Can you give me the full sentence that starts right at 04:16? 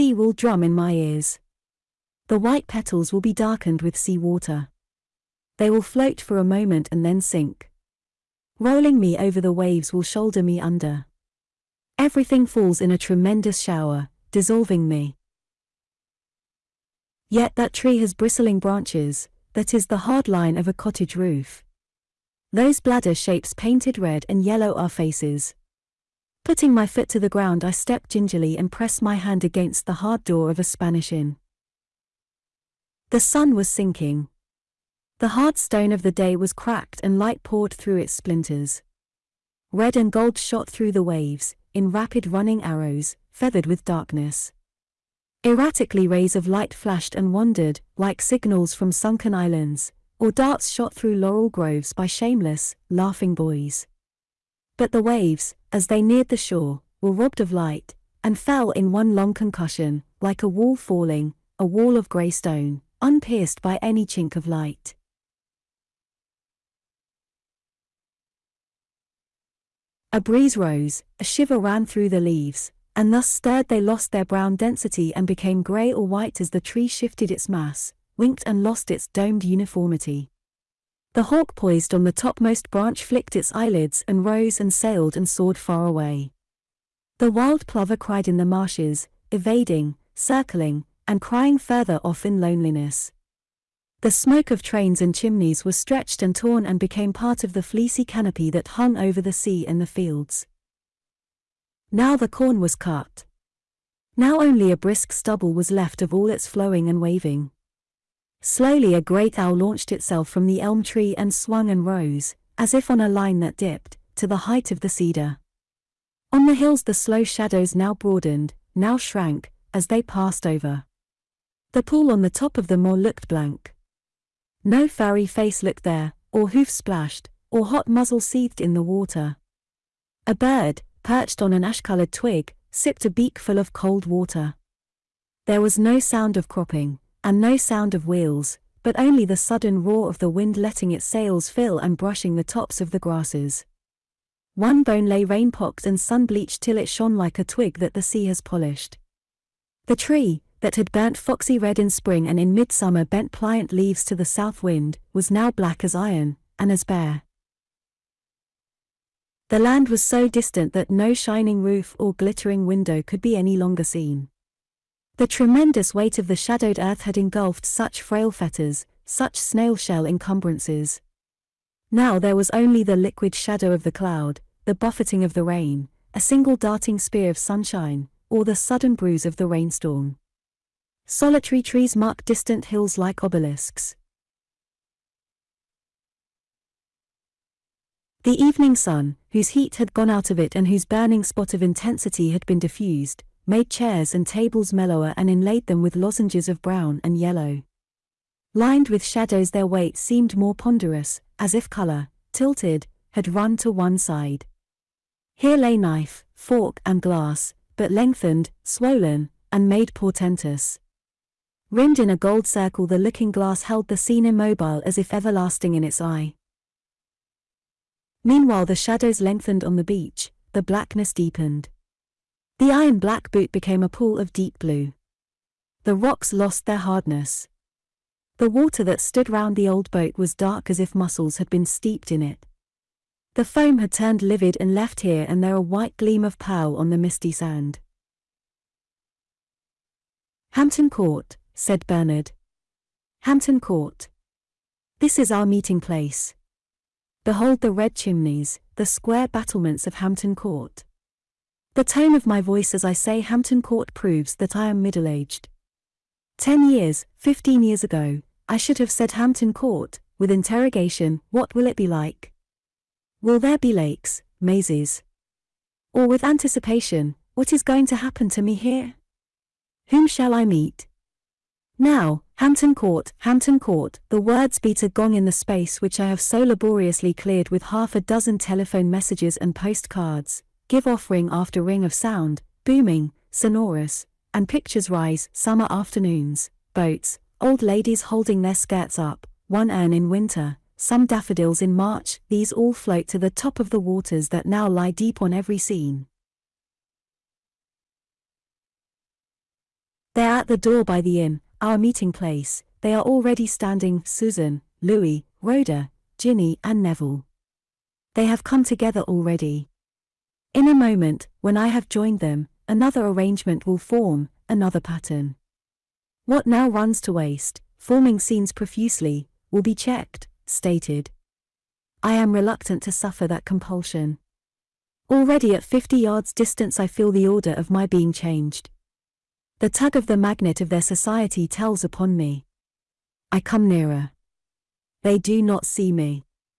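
Ten years, fifteen years ago, I should have said Hampton Court, with interrogation, what will it be like?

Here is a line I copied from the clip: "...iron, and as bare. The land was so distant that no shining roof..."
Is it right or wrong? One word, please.
right.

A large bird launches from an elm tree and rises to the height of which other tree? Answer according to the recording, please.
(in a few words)
cedar.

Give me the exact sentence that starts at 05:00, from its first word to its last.
They are at the door by the inn, our meeting place, they are already standing, Susan, Louis, Rhoda, Jinny and Neville.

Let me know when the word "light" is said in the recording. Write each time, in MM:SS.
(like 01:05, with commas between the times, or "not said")
00:37, 00:46, 00:57, 01:04.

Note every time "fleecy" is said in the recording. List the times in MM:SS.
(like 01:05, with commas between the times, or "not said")
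01:37.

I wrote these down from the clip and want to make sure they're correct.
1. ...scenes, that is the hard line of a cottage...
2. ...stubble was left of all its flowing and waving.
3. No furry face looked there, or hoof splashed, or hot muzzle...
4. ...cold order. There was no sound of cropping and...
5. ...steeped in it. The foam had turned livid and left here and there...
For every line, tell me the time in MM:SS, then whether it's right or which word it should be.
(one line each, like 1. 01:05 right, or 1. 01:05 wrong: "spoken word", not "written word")
1. 00:18 wrong: "branches", not "scenes"
2. 01:45 right
3. 02:04 right
4. 02:13 wrong: "water", not "order"
5. 03:51 right.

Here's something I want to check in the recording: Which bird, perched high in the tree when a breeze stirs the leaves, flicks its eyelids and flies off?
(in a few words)
hawk.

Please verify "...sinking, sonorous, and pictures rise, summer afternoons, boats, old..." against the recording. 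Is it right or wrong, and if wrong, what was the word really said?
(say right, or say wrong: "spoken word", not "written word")
wrong: "booming", not "sinking".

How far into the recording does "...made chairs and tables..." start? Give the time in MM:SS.
03:13.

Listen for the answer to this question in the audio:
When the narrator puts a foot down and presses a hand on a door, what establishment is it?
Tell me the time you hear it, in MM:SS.
00:30.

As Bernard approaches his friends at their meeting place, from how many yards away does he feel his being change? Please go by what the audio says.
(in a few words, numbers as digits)
50.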